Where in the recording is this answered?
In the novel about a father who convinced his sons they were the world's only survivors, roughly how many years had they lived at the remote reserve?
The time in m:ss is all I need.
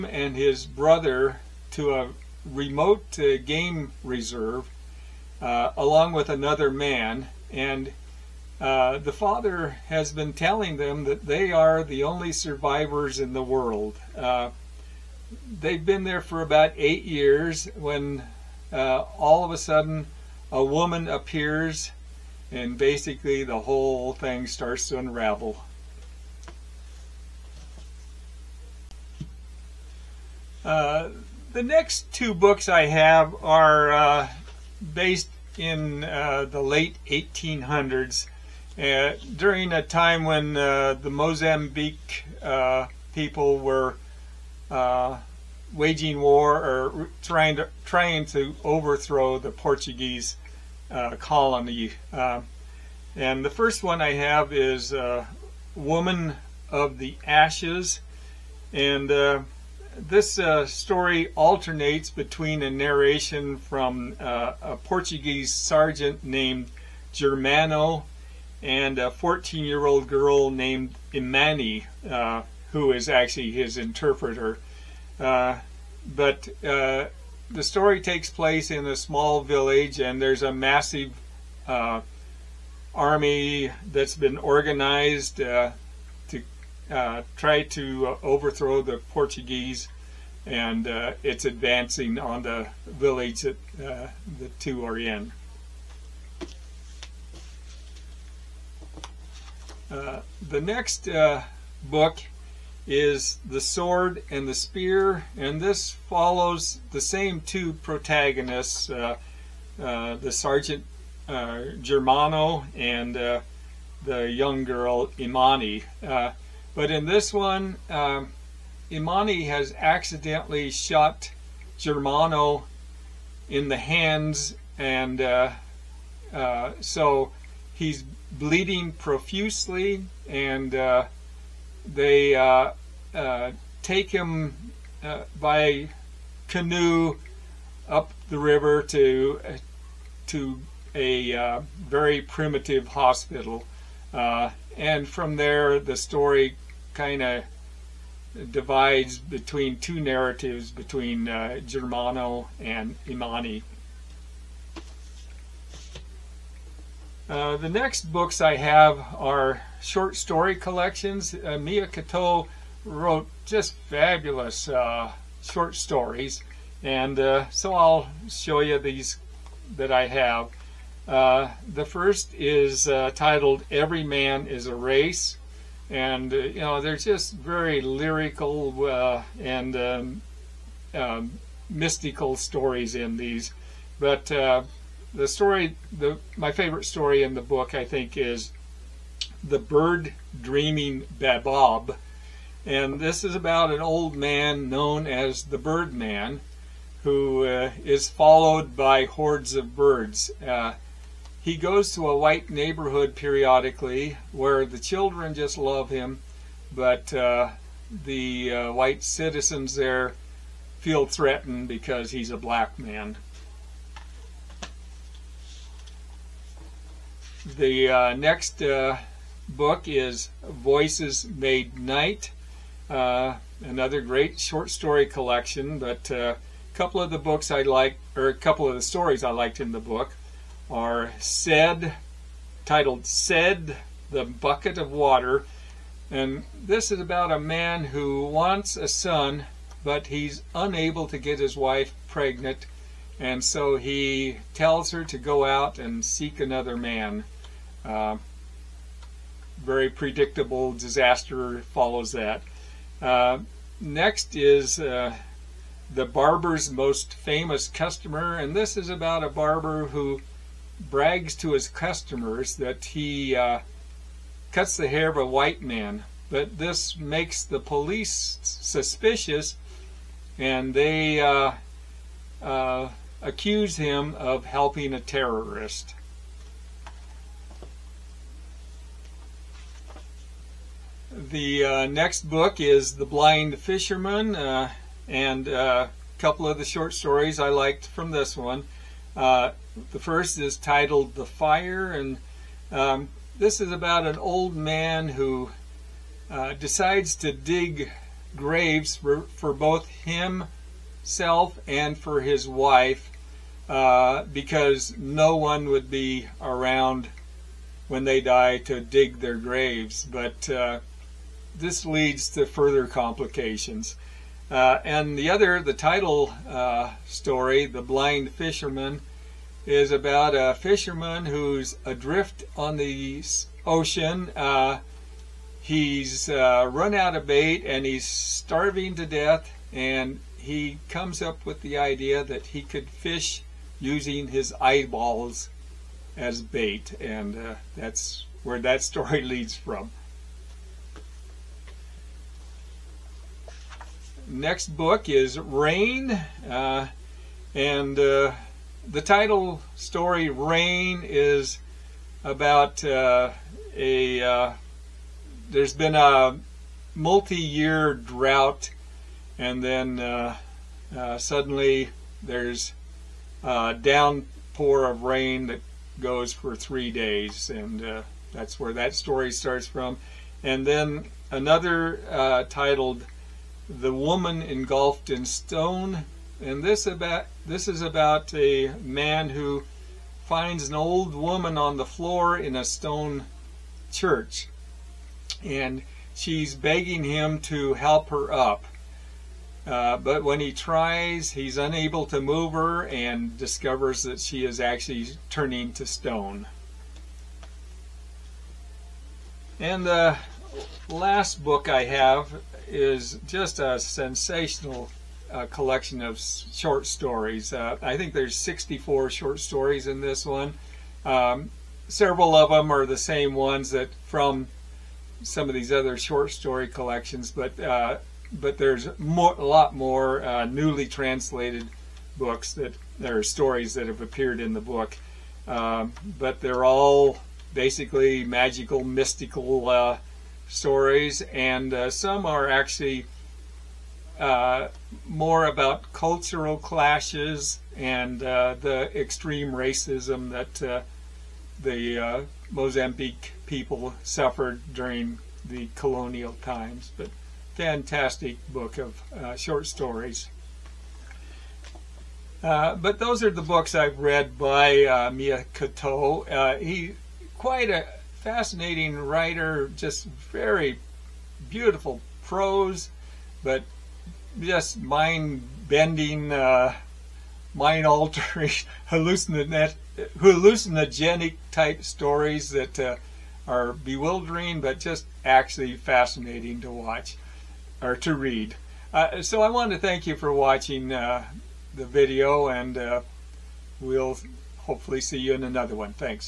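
0:16.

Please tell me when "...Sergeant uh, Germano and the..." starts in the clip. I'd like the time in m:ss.
1:50.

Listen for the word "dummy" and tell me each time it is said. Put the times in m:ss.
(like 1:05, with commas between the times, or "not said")
not said.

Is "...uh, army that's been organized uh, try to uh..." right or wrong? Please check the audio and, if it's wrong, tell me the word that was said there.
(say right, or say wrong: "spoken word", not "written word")
right.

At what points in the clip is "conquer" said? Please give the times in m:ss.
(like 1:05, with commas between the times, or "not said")
not said.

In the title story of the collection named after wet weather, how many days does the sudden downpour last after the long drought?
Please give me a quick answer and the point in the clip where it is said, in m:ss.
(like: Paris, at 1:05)
3, at 6:06.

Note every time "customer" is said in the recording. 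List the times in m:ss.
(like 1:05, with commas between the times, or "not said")
4:17, 4:21.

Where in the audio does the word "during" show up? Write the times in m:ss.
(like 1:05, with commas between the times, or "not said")
0:39, 7:24.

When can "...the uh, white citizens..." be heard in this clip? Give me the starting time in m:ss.
3:28.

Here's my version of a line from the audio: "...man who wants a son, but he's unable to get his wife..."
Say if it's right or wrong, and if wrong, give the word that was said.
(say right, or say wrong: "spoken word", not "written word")
right.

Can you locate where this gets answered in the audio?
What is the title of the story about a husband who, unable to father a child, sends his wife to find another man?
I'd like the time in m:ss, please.
3:53.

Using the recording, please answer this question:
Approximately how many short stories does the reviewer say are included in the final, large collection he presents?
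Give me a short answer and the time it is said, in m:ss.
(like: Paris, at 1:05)
64, at 6:48.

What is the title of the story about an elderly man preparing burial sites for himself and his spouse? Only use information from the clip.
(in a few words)
The Fire.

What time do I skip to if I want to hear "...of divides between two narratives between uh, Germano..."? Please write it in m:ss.
2:27.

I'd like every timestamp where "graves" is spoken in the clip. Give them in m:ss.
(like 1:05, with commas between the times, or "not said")
4:58, 5:09.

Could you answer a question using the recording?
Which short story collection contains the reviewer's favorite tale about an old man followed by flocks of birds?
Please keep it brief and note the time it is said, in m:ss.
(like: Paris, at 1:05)
Every Man is a Race, at 2:53.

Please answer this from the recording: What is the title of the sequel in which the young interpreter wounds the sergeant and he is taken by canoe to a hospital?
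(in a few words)
The Sword and the Spear.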